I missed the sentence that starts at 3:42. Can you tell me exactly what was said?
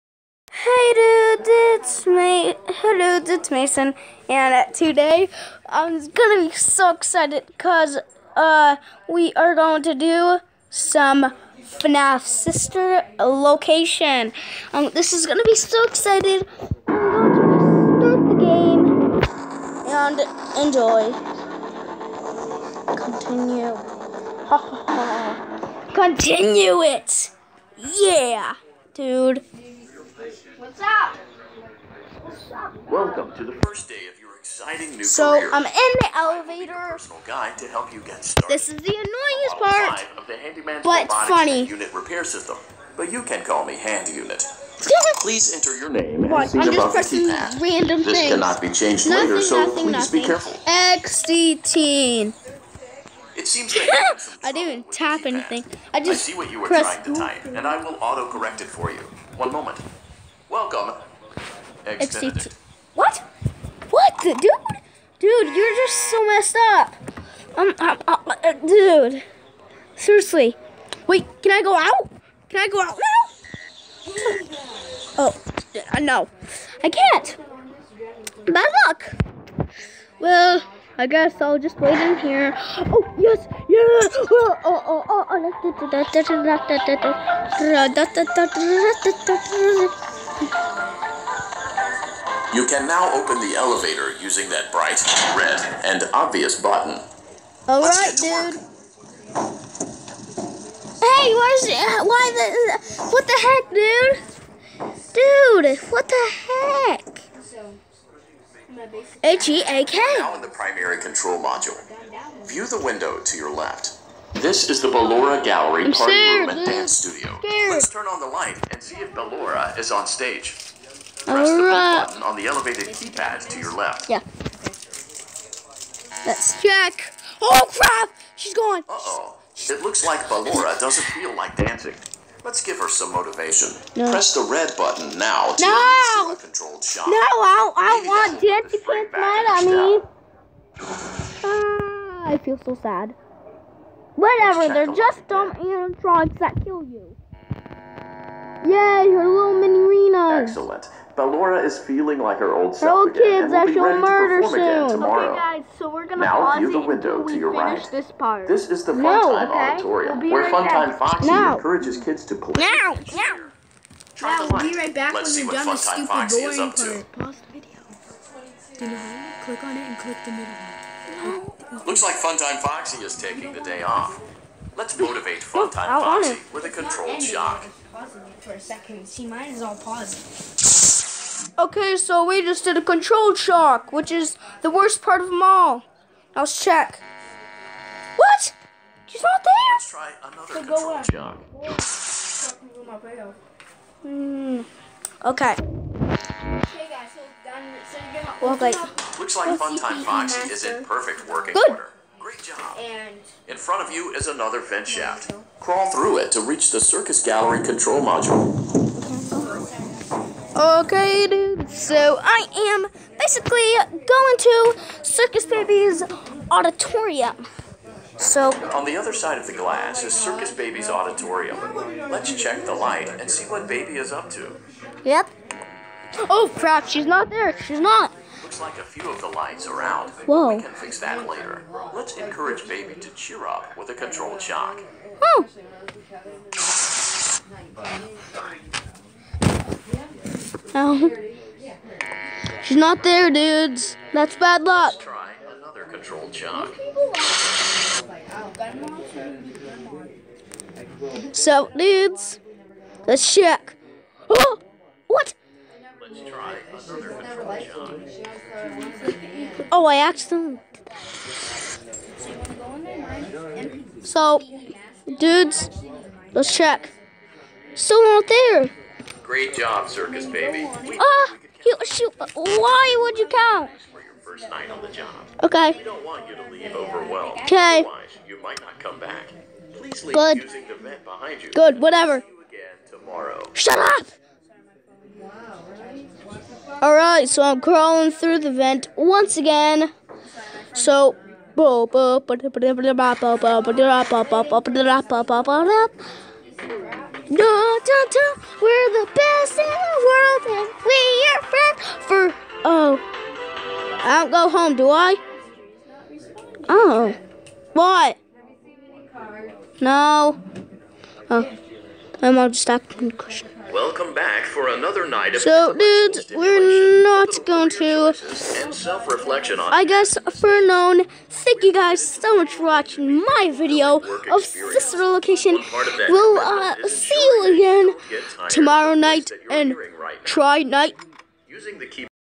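Let's check the light and see what Baby is up to.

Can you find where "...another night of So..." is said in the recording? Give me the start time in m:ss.
5:14.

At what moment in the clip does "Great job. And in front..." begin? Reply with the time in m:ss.
3:22.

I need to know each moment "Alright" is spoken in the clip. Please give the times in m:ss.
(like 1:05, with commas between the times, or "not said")
1:37, 4:46.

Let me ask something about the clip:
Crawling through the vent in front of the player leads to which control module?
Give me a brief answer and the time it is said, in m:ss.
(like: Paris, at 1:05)
circus gallery control module, at 3:26.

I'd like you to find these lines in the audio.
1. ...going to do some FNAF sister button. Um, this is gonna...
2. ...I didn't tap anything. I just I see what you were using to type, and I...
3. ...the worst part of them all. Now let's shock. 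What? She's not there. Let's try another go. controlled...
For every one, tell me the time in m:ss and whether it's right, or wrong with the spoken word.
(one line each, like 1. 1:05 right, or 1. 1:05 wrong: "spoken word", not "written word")
1. 0:09 wrong: "location", not "button"
2. 0:54 wrong: "trying", not "using"
3. 3:04 wrong: "check", not "shock".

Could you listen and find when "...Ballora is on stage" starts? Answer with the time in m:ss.
1:59.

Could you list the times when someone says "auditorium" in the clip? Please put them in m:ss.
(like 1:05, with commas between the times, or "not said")
2:39, 3:36, 3:40.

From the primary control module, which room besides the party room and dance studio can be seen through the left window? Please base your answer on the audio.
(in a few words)
Ballora Gallery.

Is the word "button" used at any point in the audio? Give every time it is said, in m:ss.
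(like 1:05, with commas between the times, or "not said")
1:36, 2:02, 2:14.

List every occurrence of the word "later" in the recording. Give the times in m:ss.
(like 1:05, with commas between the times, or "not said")
0:49, 3:51.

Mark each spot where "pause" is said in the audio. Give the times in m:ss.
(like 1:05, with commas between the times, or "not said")
2:36, 2:47.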